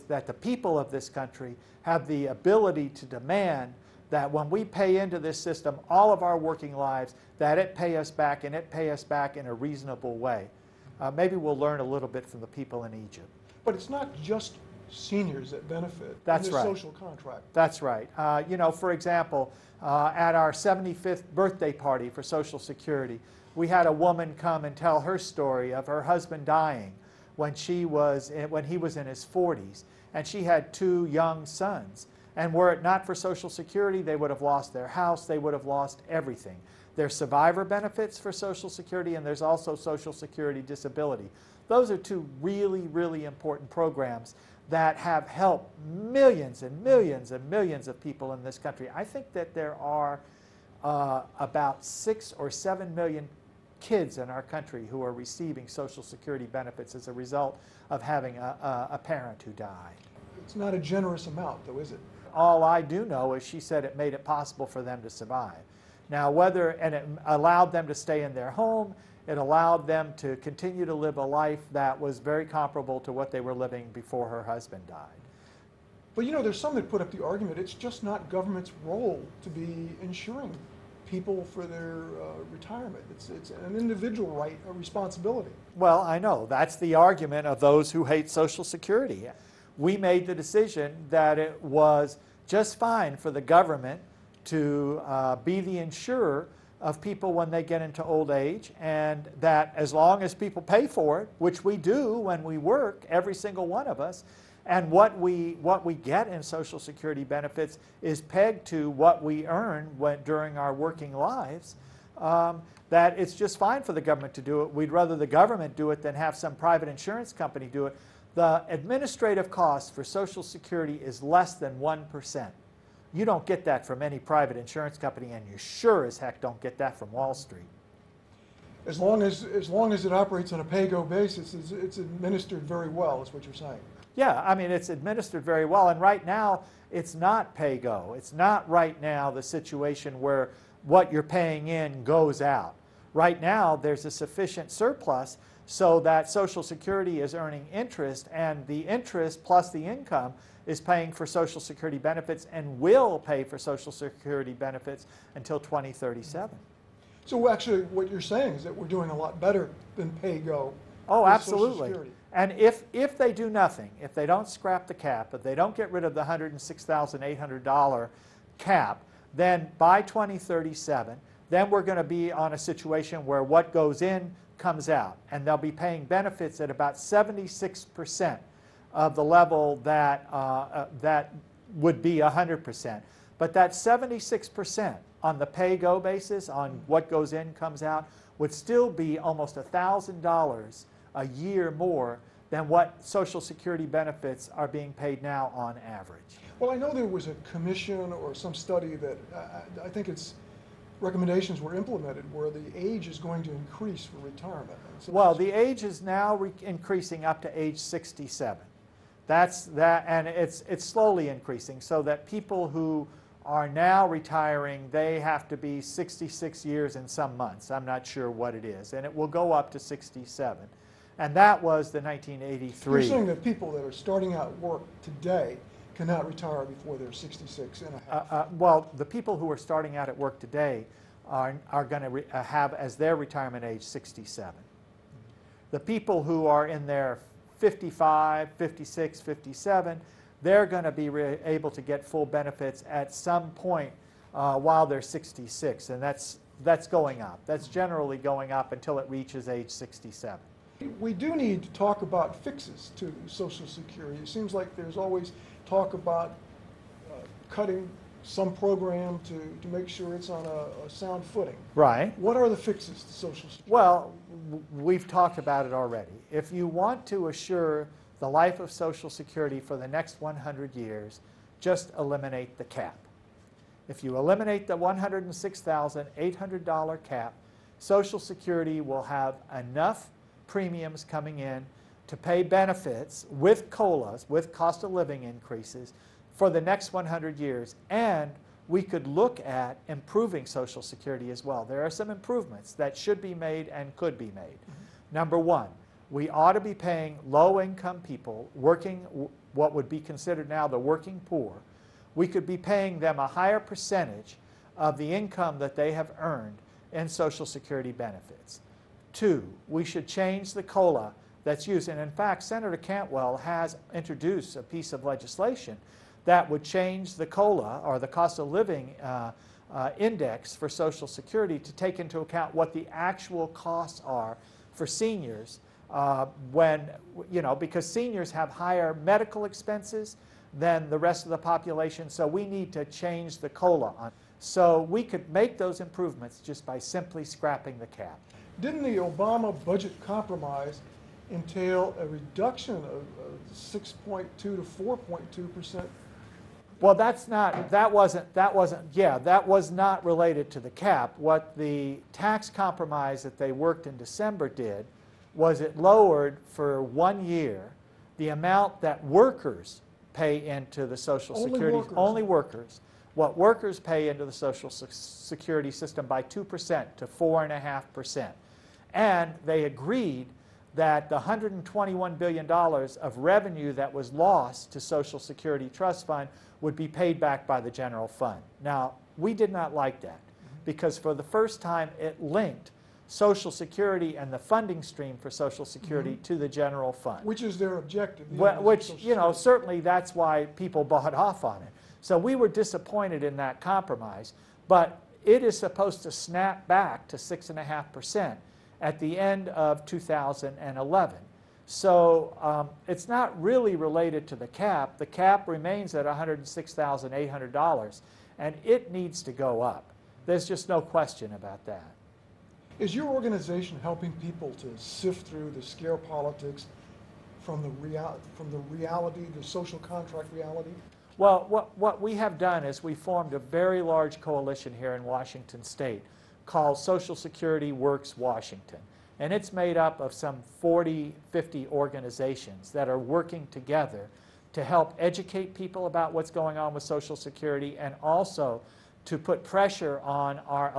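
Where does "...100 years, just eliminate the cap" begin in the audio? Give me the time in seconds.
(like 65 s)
270 s.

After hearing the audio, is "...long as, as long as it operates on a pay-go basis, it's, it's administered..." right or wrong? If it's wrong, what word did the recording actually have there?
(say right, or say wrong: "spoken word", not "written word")
right.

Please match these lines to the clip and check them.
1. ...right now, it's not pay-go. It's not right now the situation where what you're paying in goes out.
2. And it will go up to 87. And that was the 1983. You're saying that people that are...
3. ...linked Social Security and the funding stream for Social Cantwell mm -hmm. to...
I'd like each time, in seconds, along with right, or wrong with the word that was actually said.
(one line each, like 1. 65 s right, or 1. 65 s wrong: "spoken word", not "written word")
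1. 135 s right
2. 218 s wrong: "67", not "87"
3. 382 s wrong: "Security", not "Cantwell".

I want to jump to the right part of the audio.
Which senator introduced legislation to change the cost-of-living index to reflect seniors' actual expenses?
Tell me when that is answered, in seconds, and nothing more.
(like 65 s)
312 s.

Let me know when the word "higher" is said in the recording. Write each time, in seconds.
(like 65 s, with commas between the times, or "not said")
303 s, 328 s.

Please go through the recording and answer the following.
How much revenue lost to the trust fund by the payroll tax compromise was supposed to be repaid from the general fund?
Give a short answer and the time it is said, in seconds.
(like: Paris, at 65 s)
$121 billion, at 371 s.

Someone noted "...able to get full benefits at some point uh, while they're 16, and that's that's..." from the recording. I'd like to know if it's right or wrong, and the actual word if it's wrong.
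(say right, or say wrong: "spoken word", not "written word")
wrong: "66", not "16".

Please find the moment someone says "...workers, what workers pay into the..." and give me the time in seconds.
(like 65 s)
362 s.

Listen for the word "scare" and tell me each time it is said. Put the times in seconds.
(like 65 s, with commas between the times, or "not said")
415 s.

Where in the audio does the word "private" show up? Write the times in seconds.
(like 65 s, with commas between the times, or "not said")
116 s, 124 s.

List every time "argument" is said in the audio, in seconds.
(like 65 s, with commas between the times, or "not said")
77 s, 86 s.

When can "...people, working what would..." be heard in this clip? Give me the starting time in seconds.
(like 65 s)
298 s.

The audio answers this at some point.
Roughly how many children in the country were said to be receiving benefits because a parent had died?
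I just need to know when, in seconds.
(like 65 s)
51 s.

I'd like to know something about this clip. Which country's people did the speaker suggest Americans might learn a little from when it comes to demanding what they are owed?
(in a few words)
Egypt.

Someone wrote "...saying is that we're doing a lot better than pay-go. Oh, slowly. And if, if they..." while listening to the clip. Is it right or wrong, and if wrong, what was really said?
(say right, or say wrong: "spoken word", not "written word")
wrong: "absolutely", not "slowly".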